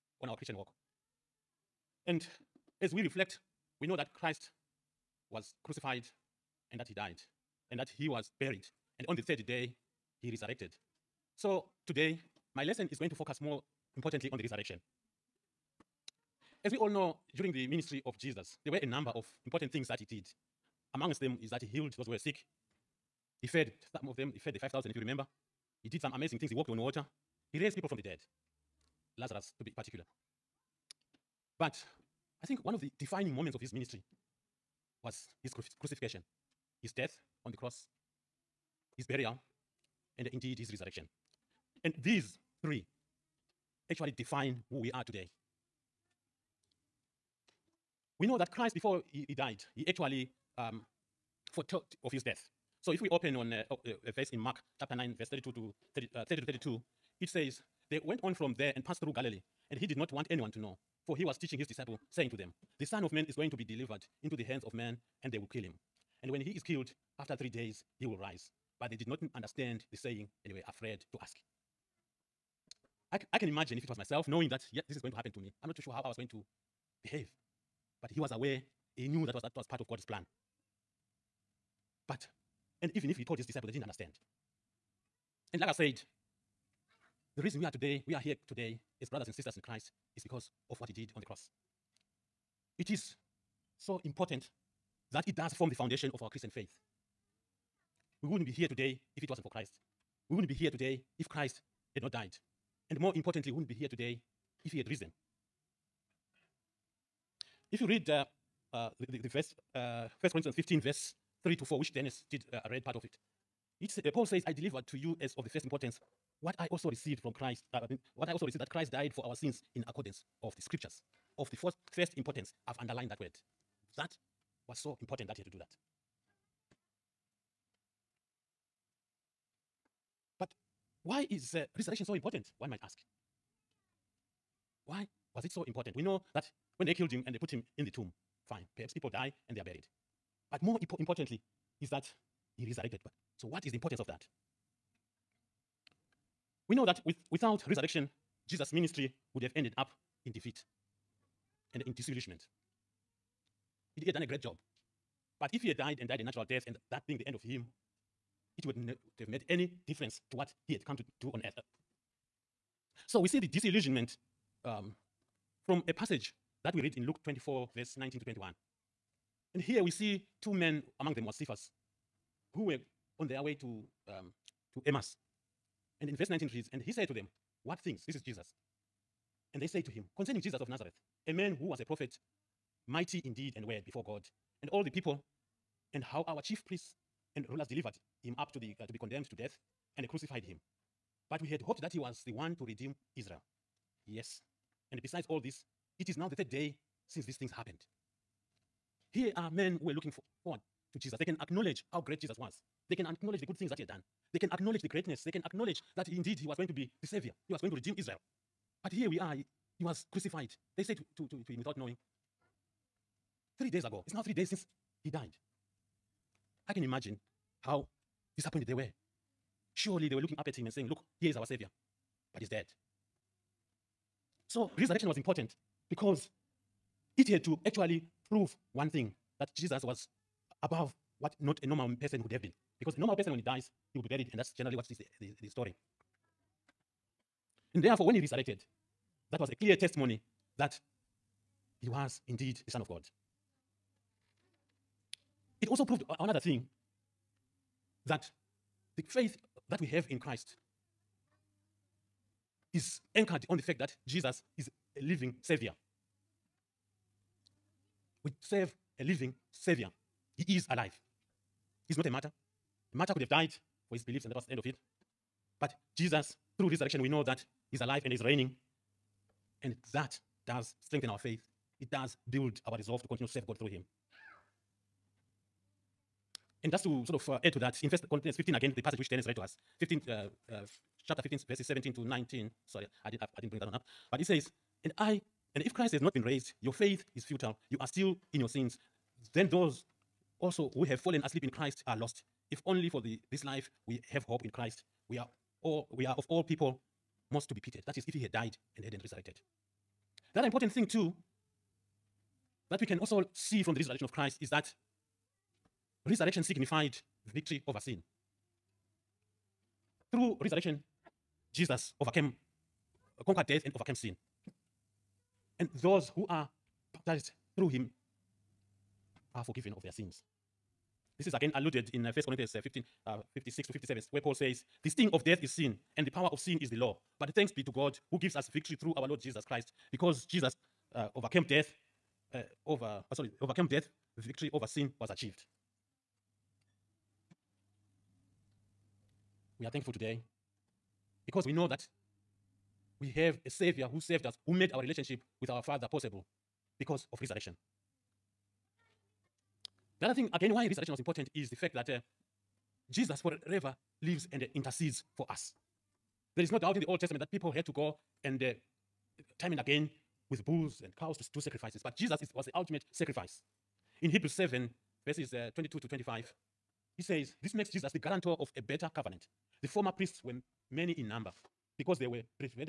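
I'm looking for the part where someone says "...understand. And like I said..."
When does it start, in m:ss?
1:23.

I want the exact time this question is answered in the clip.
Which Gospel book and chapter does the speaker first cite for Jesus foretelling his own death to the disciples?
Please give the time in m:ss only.
0:54.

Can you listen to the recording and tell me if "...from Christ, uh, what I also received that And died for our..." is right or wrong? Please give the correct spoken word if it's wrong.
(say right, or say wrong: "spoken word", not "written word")
wrong: "Christ", not "And".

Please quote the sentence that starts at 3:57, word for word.
And therefore, when he resurrected, that was a clear testimony that he was indeed the Son of God.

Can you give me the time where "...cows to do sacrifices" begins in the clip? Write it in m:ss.
6:00.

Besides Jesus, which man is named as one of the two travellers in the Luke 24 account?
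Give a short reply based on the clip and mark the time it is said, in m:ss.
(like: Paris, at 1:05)
Cephas, at 2:51.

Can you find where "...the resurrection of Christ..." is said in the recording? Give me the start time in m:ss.
5:03.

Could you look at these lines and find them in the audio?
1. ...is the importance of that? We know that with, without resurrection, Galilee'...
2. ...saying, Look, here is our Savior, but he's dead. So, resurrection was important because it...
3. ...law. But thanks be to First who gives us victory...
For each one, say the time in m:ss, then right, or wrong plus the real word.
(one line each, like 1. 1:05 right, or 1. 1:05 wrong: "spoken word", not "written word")
1. 2:23 wrong: "Jesus", not "Galilee"
2. 3:40 right
3. 5:26 wrong: "God", not "First".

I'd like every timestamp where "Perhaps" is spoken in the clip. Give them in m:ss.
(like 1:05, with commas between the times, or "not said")
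2:18.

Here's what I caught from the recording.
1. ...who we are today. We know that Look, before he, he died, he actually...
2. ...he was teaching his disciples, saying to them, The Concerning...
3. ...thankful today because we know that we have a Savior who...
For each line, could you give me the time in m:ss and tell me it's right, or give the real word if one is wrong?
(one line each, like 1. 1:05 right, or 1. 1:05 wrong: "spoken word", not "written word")
1. 0:44 wrong: "Christ", not "Look"
2. 1:01 wrong: "Son", not "Concerning"
3. 5:39 right.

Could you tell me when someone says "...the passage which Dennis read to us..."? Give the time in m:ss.
4:38.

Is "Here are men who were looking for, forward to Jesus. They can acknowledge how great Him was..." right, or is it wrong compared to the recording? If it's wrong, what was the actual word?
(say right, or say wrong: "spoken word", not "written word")
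wrong: "Jesus", not "Him".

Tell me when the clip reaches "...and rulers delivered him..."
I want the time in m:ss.
3:07.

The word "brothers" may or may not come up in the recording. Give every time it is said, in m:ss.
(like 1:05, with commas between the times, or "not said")
1:29.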